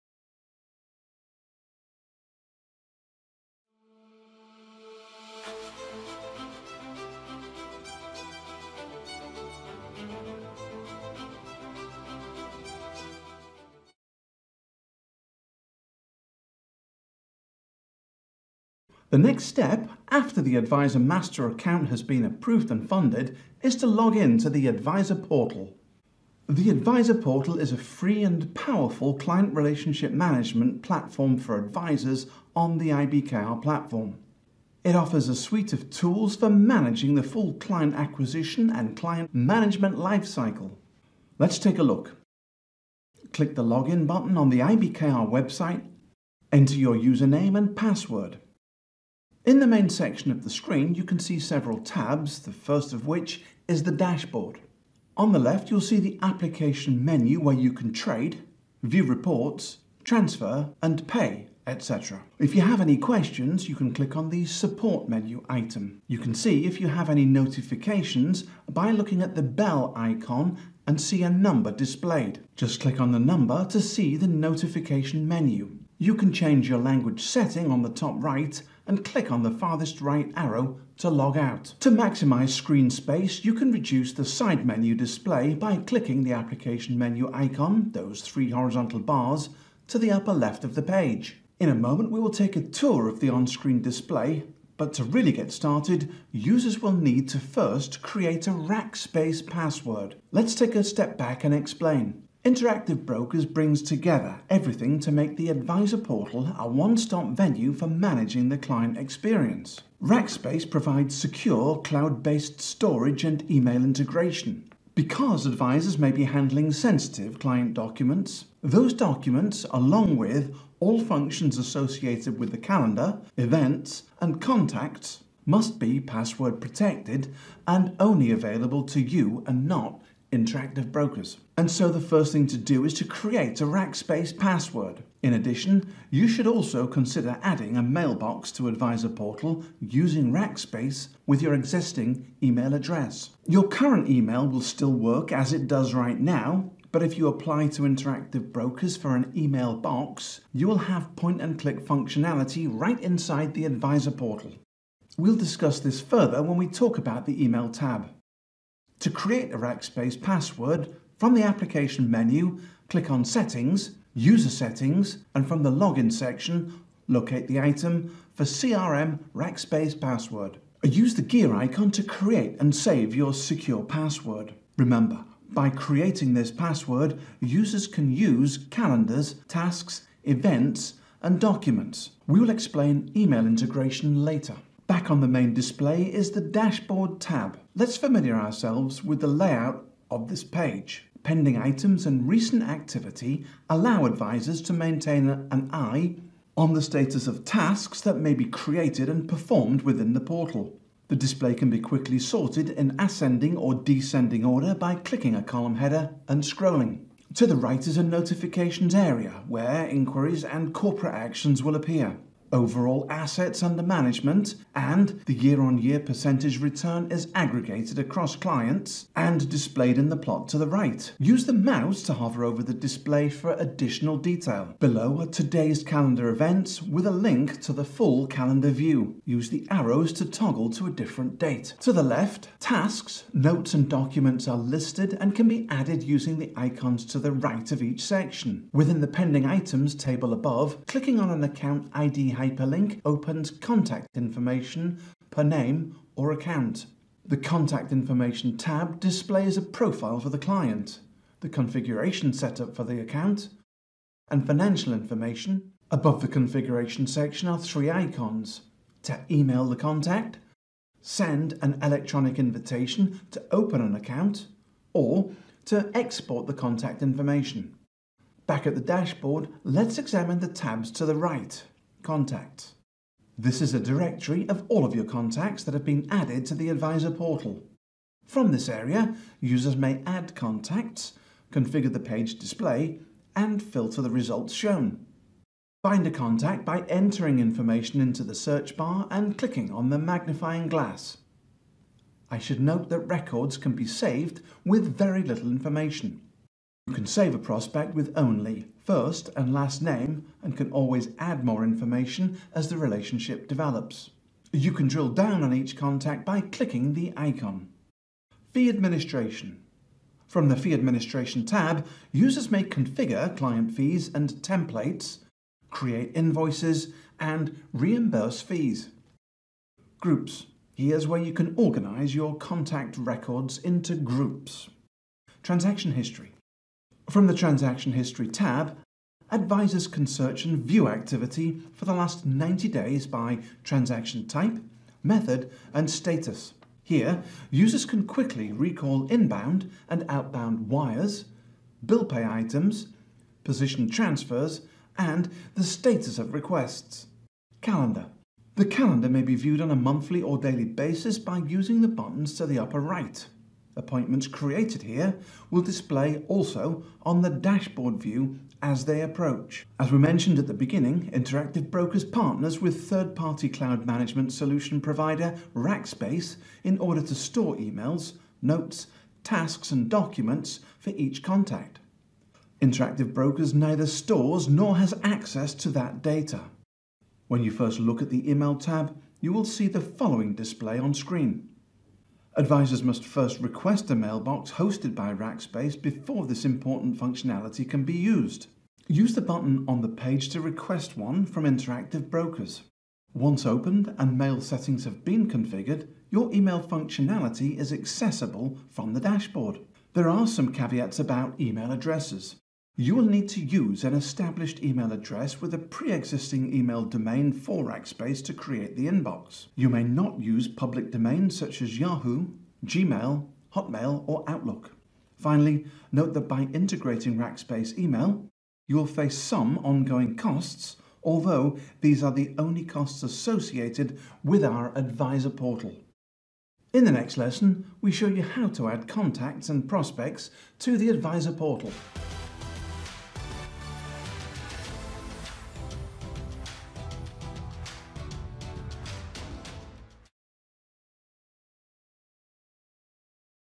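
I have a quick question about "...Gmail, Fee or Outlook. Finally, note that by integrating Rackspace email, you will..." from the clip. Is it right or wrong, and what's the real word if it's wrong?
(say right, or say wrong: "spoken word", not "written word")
wrong: "Hotmail", not "Fee".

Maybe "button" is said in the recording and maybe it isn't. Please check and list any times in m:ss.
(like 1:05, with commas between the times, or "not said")
0:44, 5:51, 6:29.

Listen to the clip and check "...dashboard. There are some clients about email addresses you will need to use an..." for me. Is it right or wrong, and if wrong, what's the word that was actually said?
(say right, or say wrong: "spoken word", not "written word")
wrong: "caveats", not "clients".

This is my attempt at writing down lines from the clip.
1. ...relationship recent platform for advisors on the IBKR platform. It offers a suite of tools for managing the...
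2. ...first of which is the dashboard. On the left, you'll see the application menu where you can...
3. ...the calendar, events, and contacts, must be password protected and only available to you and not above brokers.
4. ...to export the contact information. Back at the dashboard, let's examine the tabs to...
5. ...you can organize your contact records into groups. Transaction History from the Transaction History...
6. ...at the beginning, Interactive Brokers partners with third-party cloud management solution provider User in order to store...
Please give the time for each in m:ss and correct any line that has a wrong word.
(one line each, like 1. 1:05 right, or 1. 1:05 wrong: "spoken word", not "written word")
1. 0:29 wrong: "management", not "recent"
2. 0:52 right
3. 2:02 wrong: "interactive", not "above"
4. 4:25 right
5. 5:21 right
6. 6:00 wrong: "Rackspace", not "User".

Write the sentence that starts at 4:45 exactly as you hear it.
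Find a contact by entering information into the search bar and clicking on the magnifying glass.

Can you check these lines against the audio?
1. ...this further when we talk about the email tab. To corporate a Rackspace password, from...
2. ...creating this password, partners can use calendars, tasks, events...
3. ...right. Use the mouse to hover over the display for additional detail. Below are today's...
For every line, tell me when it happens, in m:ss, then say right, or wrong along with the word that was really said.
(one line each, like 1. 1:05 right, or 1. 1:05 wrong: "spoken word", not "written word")
1. 2:35 wrong: "create", not "corporate"
2. 2:55 wrong: "users", not "partners"
3. 3:40 right.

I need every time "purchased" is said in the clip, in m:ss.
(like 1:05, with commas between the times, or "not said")
not said.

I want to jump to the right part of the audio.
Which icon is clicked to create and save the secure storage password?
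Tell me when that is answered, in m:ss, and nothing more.
2:51.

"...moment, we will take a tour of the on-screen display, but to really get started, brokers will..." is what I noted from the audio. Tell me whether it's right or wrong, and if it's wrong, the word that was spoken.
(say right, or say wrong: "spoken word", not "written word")
wrong: "users", not "brokers".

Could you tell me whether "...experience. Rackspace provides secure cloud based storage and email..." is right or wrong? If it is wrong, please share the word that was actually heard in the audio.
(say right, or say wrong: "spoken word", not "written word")
right.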